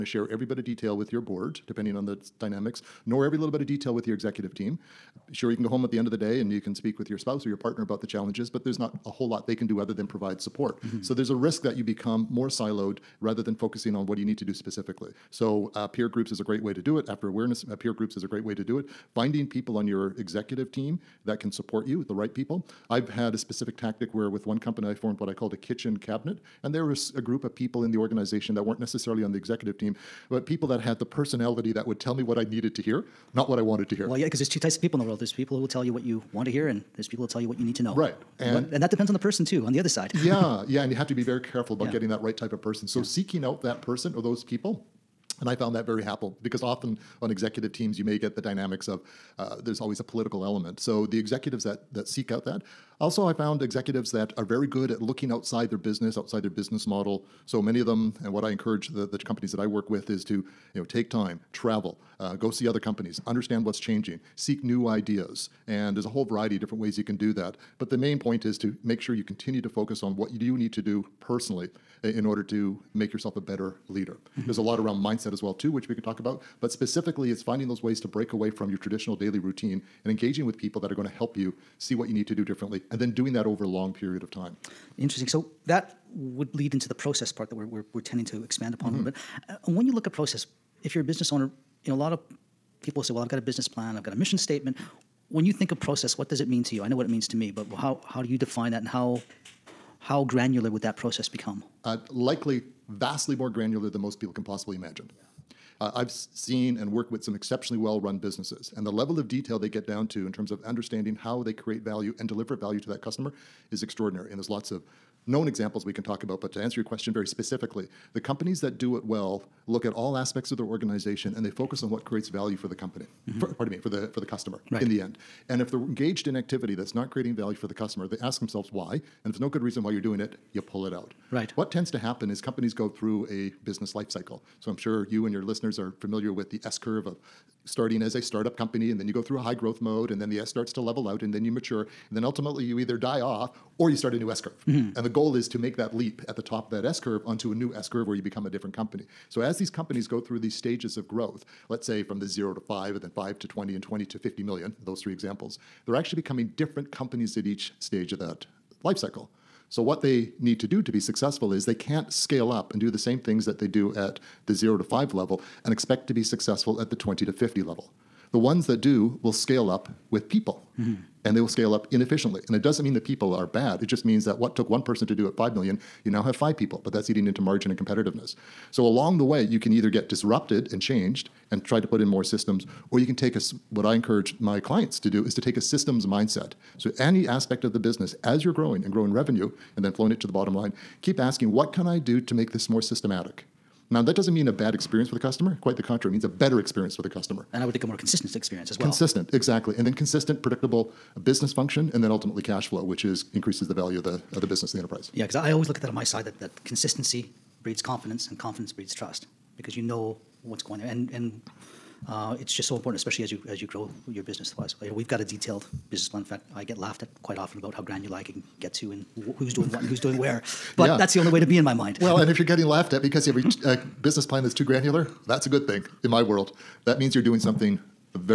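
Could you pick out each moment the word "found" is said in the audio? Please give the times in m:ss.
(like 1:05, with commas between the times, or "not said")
0:45, 0:53.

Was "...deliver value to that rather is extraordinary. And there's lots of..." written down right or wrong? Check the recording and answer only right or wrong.
wrong.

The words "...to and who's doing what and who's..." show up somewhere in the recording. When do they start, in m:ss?
3:38.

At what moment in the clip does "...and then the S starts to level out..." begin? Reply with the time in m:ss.
2:20.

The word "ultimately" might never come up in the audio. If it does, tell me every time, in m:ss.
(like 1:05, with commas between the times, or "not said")
2:22, 3:22.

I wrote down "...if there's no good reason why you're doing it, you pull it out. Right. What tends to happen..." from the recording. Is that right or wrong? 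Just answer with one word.
right.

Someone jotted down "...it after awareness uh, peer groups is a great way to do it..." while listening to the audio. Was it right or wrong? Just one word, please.
right.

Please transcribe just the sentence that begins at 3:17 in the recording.
And I would think a more consistent experience as well.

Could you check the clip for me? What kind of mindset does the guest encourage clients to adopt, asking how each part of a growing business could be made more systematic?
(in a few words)
systems mindset.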